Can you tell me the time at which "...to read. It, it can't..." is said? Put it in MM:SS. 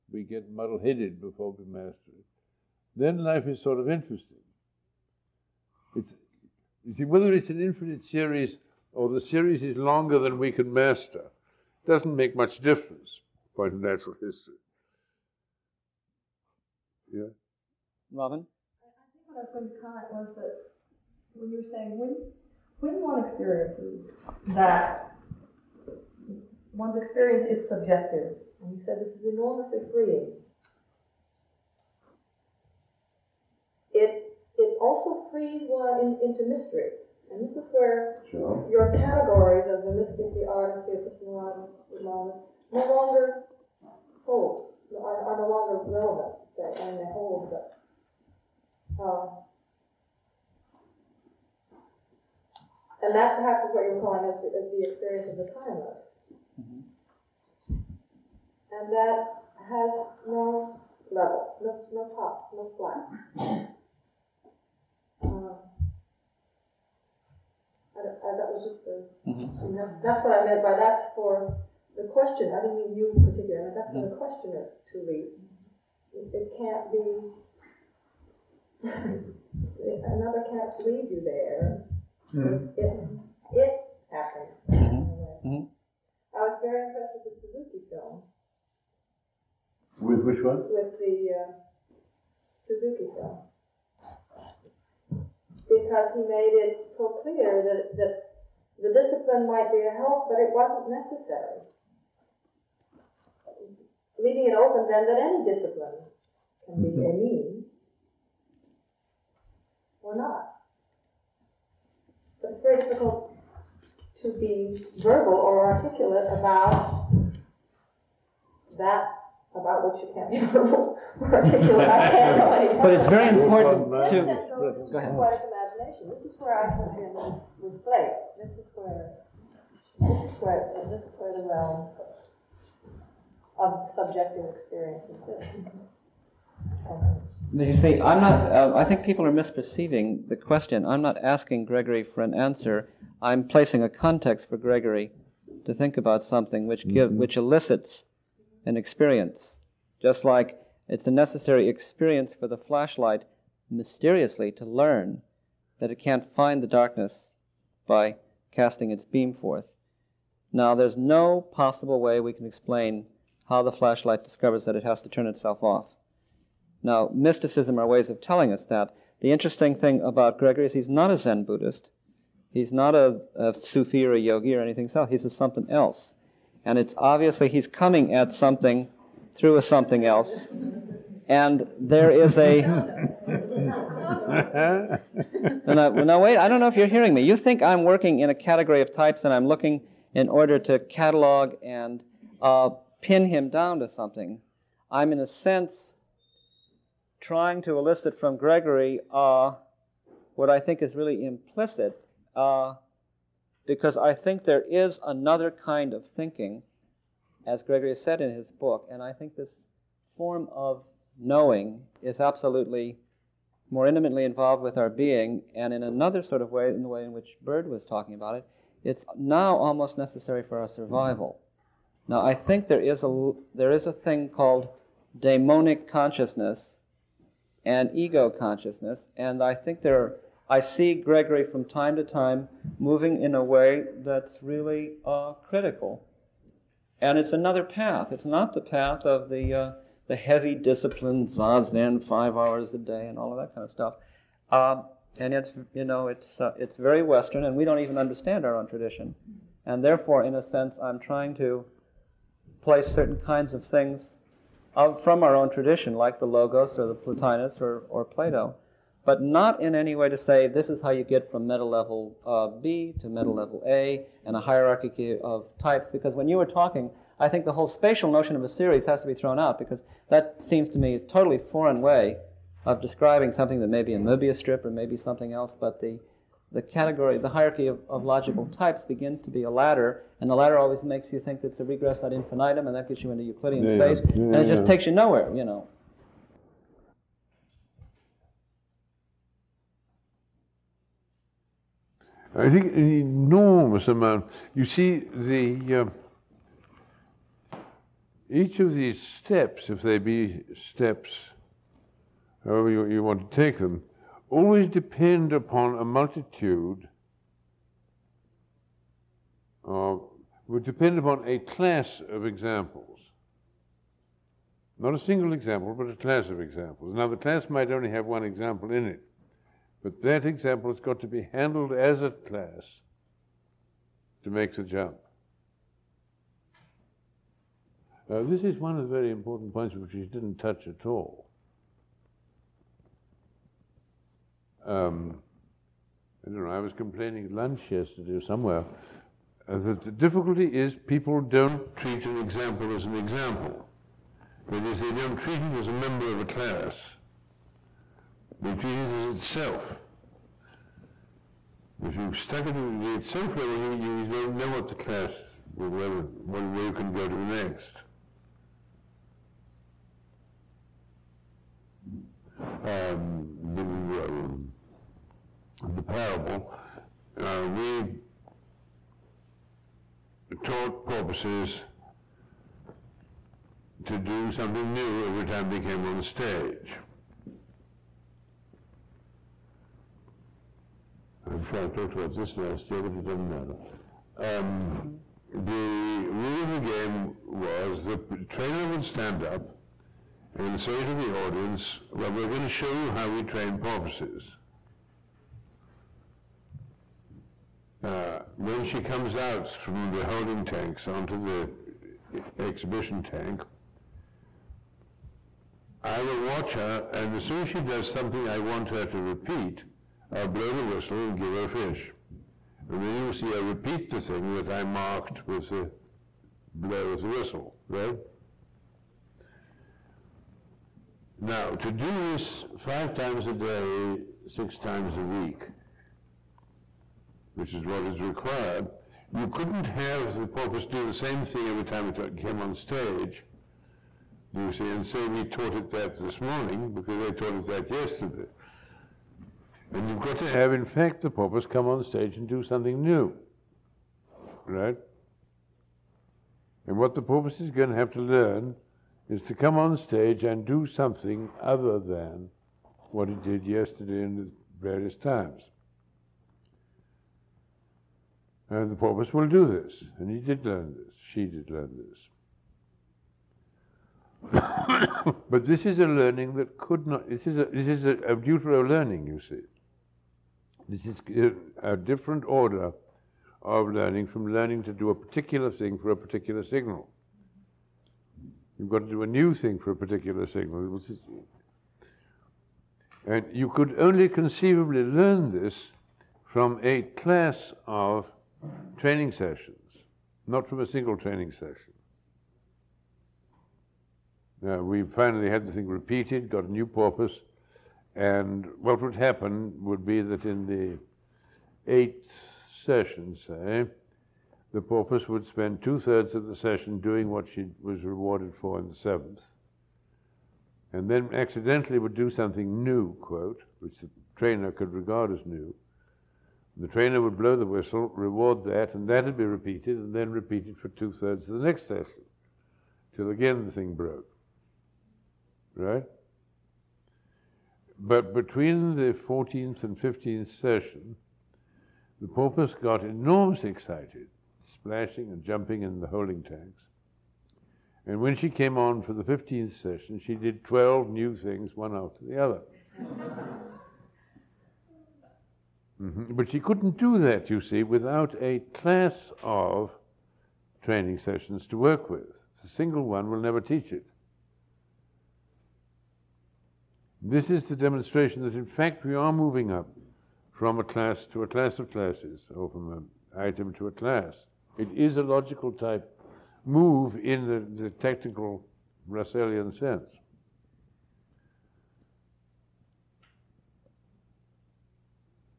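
01:14.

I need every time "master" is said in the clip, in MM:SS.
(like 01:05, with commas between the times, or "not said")
00:01, 00:10.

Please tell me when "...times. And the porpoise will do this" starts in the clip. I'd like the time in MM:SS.
07:35.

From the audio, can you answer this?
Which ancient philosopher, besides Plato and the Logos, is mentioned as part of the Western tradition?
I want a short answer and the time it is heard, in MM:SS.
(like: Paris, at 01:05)
Plotinus, at 04:16.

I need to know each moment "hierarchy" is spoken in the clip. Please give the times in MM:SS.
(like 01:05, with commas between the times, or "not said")
04:24, 04:37.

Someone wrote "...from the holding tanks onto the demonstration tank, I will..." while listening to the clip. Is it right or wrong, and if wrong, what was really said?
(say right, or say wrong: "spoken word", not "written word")
wrong: "exhibition", not "demonstration".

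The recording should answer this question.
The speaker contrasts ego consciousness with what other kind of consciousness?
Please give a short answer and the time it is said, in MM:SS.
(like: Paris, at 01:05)
daemonic consciousness, at 03:45.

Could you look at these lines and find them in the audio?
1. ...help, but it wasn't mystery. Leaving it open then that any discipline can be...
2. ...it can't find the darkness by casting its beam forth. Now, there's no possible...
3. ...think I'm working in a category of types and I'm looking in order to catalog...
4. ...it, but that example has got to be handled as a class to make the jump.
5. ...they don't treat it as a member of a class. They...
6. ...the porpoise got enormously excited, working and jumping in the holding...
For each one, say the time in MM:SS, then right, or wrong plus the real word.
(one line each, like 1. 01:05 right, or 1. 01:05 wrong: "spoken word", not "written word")
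1. 01:39 wrong: "necessary", not "mystery"
2. 02:35 right
3. 03:07 right
4. 05:18 right
5. 05:44 right
6. 08:52 wrong: "splashing", not "working".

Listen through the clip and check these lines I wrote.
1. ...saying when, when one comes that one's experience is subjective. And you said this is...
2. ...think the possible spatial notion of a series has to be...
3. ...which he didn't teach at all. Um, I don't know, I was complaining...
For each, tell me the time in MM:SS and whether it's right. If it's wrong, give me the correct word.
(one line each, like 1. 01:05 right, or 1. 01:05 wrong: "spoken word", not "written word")
1. 00:21 wrong: "experiences", not "comes"
2. 04:27 wrong: "whole", not "possible"
3. 05:29 wrong: "touch", not "teach".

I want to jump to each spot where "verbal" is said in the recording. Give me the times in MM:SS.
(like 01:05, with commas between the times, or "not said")
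01:54, 02:00.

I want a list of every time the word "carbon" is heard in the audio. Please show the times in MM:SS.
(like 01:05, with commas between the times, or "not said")
not said.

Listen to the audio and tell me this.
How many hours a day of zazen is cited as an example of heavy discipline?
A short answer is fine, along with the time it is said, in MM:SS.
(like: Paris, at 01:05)
5, at 04:02.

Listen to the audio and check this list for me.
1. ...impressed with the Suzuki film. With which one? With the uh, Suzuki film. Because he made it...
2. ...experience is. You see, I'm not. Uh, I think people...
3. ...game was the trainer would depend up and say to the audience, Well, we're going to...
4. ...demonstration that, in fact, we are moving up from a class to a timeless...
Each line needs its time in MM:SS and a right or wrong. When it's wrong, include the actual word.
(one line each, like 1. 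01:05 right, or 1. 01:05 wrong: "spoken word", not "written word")
1. 01:26 right
2. 02:14 right
3. 06:26 wrong: "stand", not "depend"
4. 09:17 wrong: "class", not "timeless".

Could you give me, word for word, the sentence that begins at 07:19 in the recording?
And you've got to have, in fact, the porpoise come on stage and do something new, right?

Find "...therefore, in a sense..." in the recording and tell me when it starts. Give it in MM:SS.
04:09.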